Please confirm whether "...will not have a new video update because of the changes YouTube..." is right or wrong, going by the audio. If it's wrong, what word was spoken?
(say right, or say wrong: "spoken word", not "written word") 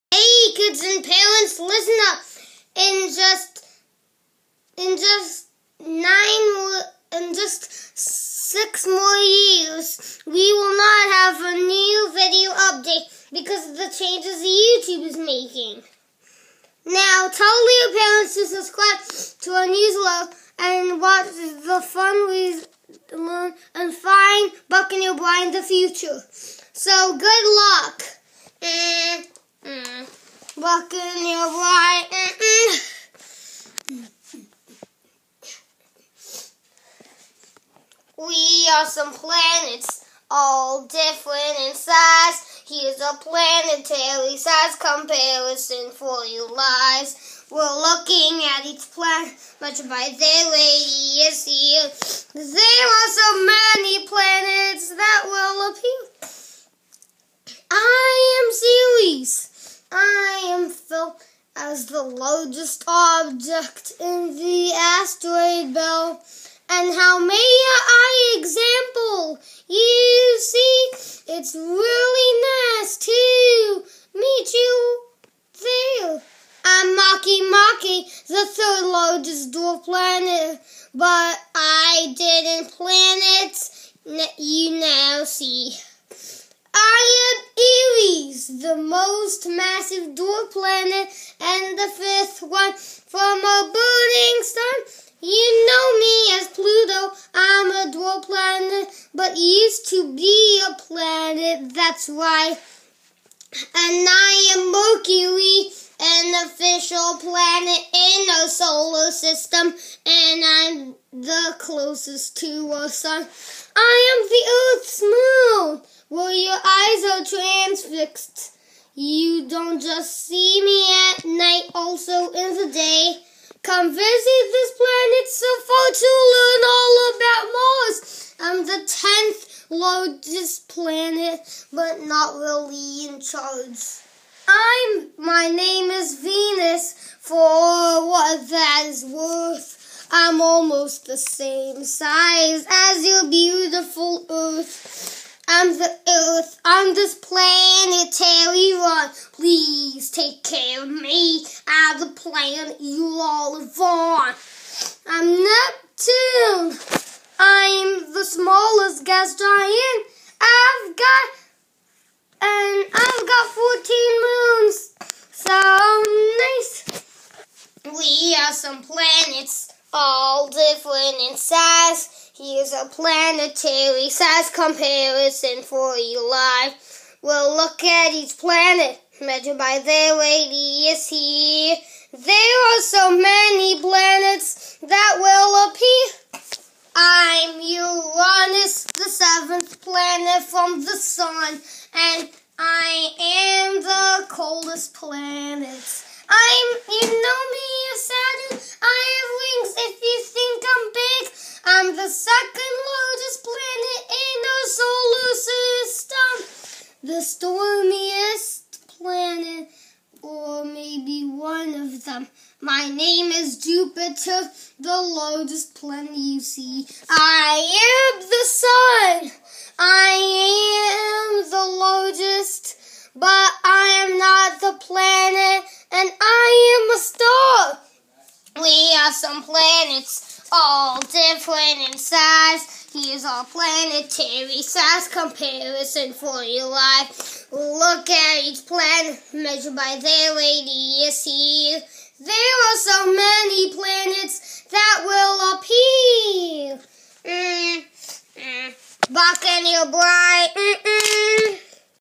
right.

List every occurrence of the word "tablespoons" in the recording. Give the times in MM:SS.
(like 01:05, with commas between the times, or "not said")
not said.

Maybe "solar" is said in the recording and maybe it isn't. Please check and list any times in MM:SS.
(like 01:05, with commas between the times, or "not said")
01:48, 03:25.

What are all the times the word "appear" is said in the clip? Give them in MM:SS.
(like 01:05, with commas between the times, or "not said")
00:55, 03:05, 04:05.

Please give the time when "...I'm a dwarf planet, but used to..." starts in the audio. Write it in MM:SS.
01:37.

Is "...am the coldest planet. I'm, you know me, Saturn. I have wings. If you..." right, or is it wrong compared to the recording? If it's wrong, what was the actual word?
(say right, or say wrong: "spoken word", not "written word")
right.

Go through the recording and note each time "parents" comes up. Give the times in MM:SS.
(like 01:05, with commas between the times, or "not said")
00:01, 00:17.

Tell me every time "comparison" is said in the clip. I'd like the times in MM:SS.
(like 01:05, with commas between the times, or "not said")
00:44, 02:54, 03:55.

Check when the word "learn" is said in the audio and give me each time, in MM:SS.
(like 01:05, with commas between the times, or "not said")
00:23, 02:06.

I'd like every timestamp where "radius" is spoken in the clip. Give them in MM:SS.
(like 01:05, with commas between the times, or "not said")
00:50, 03:00, 04:00.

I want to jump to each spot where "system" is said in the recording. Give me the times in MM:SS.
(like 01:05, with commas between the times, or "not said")
01:49, 03:26.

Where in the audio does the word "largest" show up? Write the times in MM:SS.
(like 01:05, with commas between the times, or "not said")
01:02, 01:18, 02:09, 03:22, 03:35.